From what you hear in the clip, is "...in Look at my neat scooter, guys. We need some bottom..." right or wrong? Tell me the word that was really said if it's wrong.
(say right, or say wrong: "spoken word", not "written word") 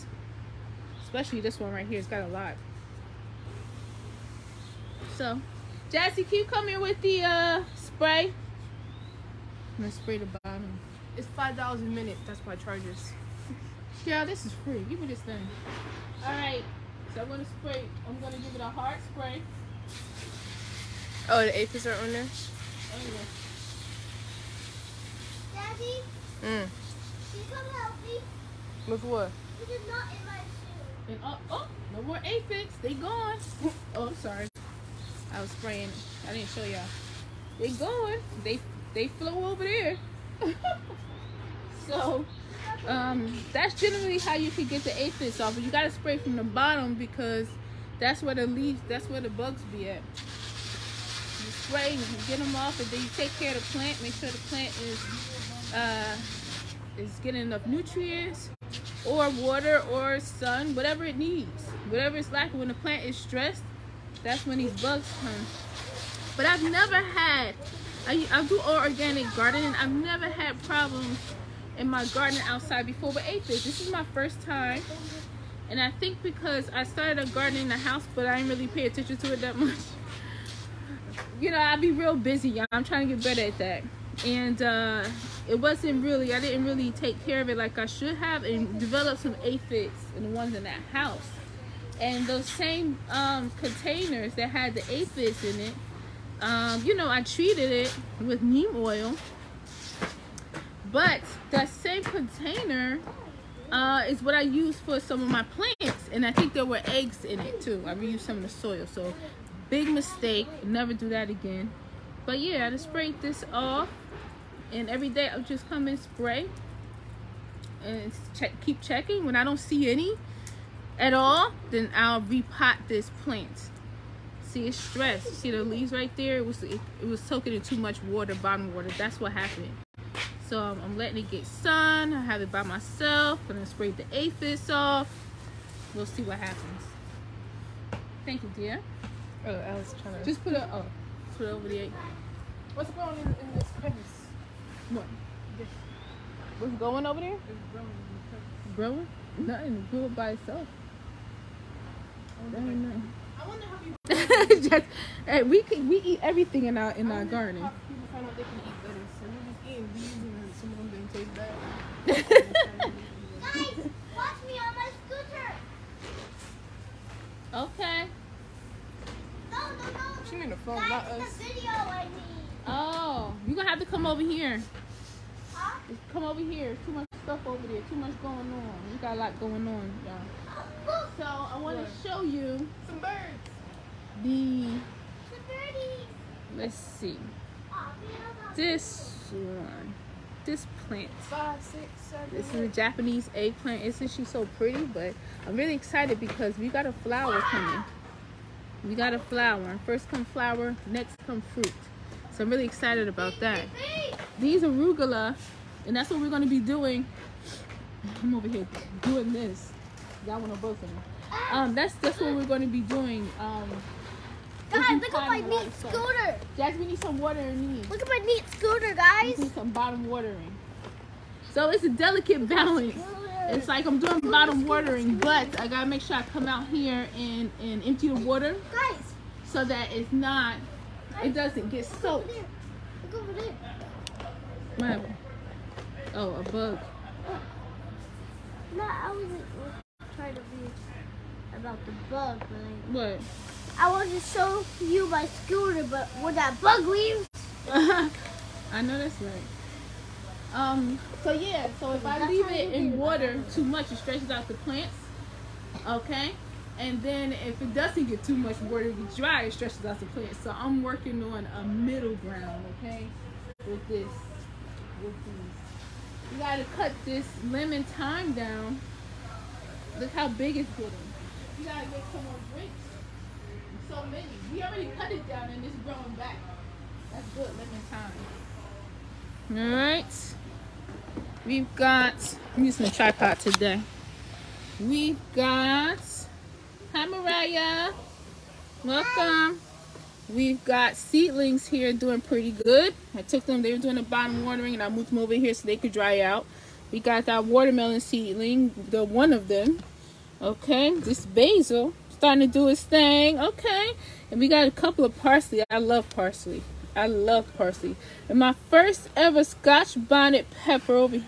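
right.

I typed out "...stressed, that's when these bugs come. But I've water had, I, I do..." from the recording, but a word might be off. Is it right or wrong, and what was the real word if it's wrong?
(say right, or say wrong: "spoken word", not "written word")
wrong: "never", not "water".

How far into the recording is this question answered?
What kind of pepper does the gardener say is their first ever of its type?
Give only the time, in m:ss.
5:09.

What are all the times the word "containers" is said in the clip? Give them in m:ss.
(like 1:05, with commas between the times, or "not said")
1:33, 1:42.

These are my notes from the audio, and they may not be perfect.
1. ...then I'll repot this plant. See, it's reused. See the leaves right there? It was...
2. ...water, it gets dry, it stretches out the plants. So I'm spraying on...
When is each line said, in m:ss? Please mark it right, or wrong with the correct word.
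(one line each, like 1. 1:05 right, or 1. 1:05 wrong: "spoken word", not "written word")
1. 2:01 wrong: "stressed", not "reused"
2. 4:18 wrong: "working", not "spraying".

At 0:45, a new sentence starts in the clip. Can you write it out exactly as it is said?
But you gotta spray from the bottom because that's where the leaves, that's where the bugs be at.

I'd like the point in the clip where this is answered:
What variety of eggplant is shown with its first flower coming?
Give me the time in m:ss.
3:12.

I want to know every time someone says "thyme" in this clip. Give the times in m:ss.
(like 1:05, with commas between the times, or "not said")
4:27, 4:37.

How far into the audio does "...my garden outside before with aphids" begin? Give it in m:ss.
1:11.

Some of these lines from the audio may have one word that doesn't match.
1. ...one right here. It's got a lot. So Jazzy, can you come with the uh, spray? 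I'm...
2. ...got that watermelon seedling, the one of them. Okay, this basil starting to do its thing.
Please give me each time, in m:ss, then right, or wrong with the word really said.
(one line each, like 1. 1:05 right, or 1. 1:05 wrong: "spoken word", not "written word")
1. 0:01 right
2. 4:56 right.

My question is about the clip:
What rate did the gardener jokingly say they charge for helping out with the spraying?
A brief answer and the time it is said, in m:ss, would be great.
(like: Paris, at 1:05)
$5 a minute, at 0:11.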